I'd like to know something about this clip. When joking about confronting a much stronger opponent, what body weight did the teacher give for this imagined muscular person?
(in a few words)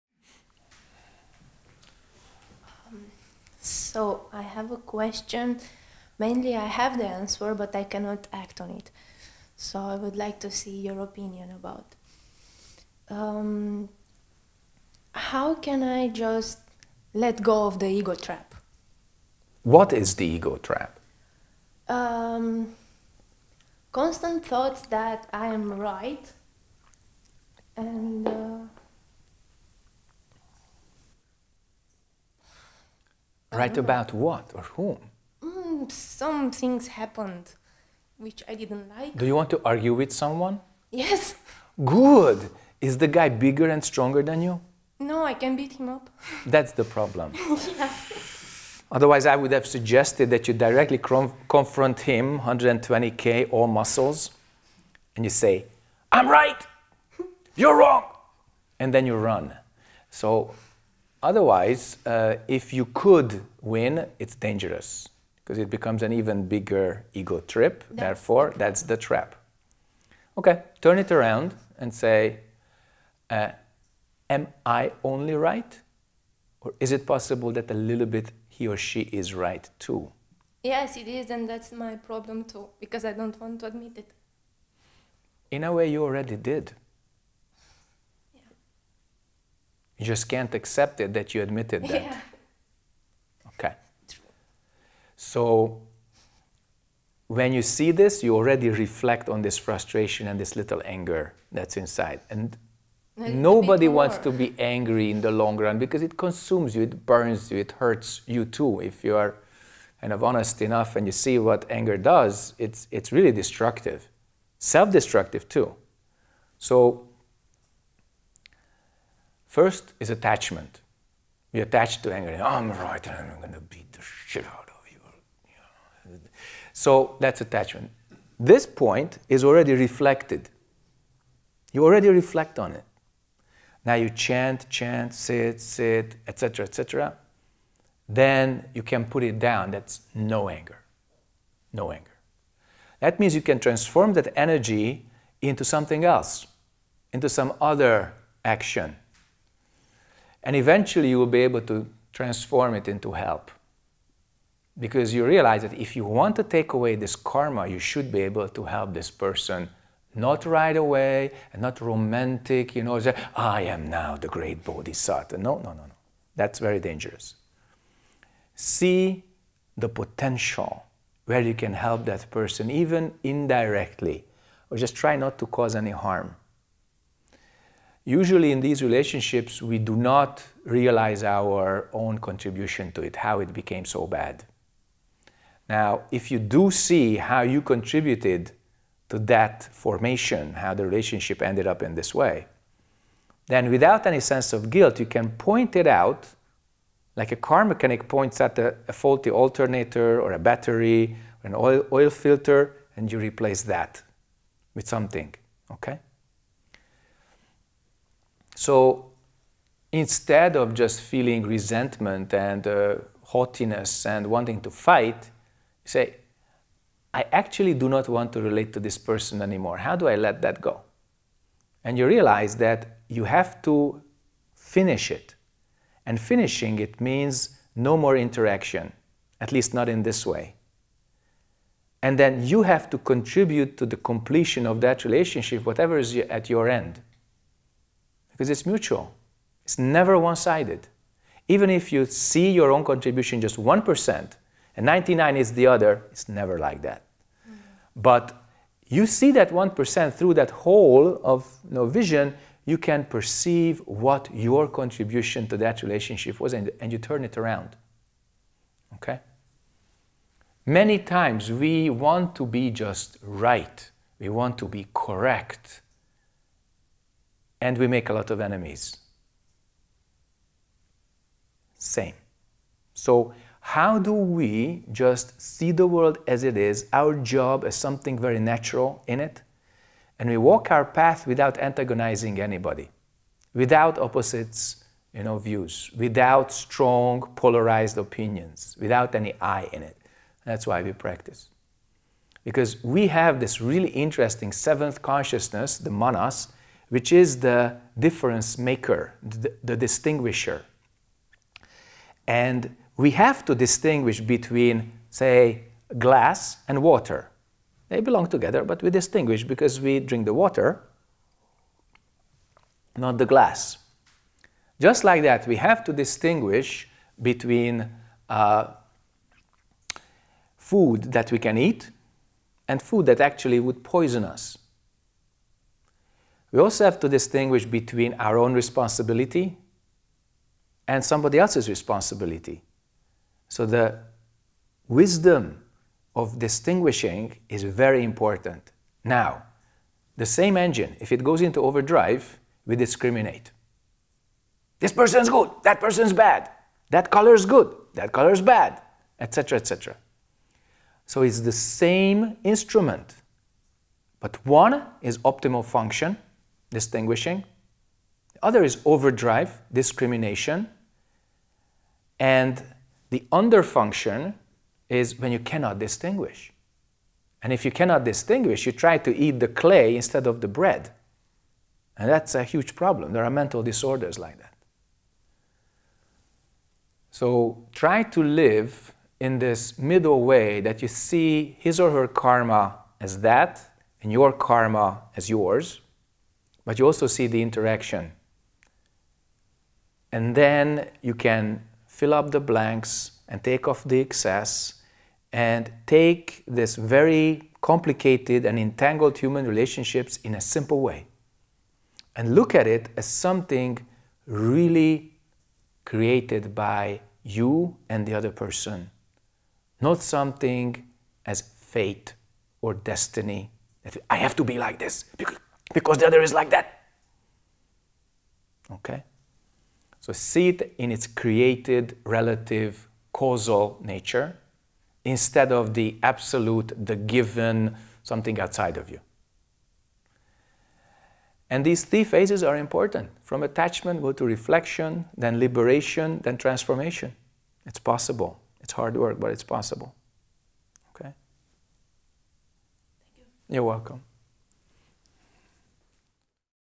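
120K.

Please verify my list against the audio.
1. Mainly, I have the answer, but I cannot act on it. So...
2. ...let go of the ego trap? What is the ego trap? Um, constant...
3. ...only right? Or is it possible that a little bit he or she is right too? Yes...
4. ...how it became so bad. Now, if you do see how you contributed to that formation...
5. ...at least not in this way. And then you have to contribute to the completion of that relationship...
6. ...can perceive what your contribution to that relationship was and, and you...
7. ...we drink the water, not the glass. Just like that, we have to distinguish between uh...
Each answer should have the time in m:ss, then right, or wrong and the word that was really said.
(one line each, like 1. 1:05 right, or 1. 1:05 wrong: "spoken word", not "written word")
1. 0:06 right
2. 0:17 right
3. 1:15 right
4. 3:03 right
5. 3:49 right
6. 4:12 right
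7. 5:09 right.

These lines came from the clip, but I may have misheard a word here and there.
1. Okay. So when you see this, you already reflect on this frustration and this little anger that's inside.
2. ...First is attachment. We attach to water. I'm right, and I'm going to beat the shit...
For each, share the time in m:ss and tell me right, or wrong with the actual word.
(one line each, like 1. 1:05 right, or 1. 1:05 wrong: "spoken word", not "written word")
1. 1:33 right
2. 1:59 wrong: "anger", not "water".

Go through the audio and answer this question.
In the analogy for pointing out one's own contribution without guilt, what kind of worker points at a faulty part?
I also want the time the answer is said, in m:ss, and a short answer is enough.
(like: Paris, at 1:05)
car mechanic, at 3:17.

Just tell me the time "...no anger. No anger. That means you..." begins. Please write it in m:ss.
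2:20.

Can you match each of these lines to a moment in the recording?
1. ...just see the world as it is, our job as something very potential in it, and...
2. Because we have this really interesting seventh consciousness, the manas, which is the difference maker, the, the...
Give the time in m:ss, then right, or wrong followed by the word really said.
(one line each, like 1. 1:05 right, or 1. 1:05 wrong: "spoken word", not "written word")
1. 4:34 wrong: "natural", not "potential"
2. 4:52 right.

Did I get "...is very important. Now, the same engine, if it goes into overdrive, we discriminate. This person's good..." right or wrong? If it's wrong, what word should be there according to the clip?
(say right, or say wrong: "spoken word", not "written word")
right.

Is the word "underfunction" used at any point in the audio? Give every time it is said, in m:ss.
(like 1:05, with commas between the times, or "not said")
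6:03.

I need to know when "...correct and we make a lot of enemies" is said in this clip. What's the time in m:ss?
4:24.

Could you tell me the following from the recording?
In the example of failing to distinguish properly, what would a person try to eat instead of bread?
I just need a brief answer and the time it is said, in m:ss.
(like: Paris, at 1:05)
clay, at 6:09.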